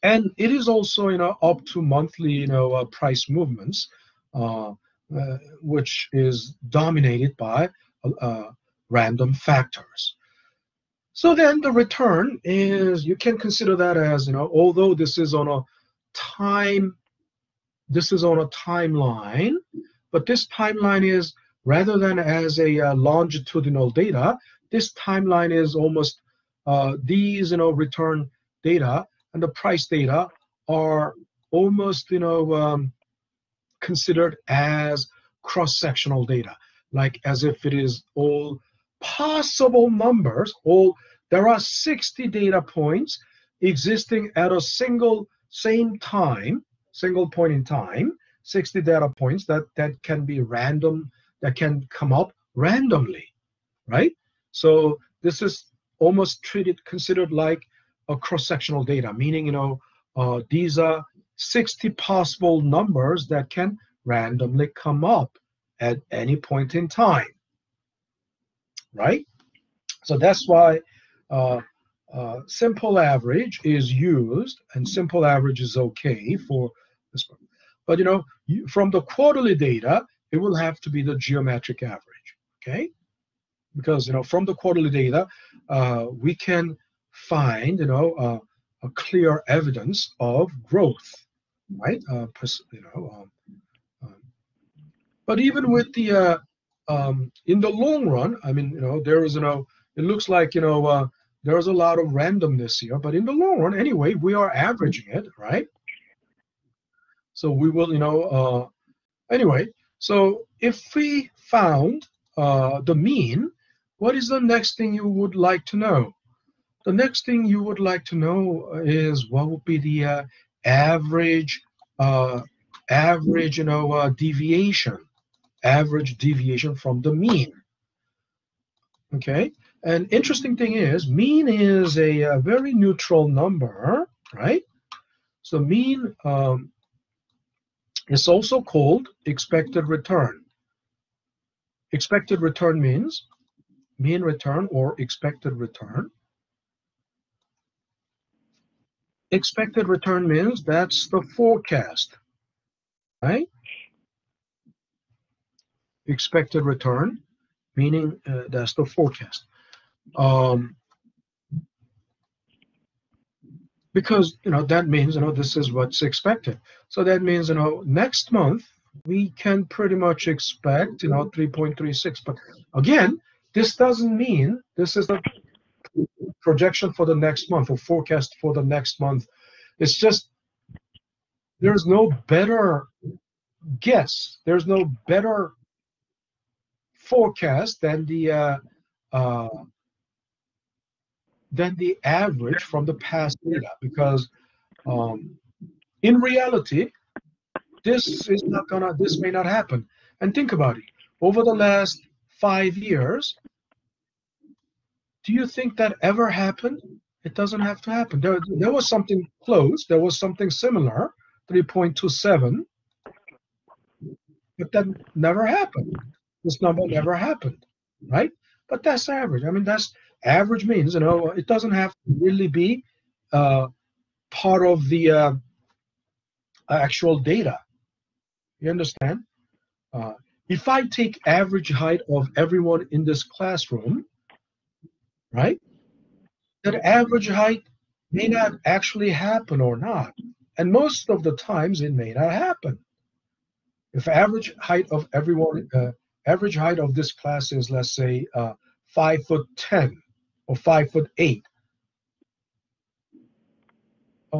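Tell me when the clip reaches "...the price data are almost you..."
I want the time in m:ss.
0:29.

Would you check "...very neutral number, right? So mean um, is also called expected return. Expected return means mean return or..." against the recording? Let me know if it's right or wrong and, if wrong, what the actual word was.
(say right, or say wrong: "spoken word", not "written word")
right.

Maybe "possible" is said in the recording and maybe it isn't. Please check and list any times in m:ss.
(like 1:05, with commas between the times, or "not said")
0:39, 1:01.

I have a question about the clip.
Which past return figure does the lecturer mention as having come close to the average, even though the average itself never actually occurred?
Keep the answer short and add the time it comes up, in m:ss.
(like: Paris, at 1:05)
3.27, at 3:31.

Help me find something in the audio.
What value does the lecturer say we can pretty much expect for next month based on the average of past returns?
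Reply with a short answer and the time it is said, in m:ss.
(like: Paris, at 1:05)
3.36, at 2:51.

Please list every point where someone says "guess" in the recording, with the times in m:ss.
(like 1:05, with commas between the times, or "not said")
3:03.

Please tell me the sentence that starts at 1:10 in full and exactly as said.
So that's why uh, uh, simple average is used, and simple average is okay for this one.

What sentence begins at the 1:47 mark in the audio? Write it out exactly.
So we will, you know, uh, anyway.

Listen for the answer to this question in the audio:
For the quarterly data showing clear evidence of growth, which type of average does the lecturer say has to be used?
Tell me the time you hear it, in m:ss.
1:21.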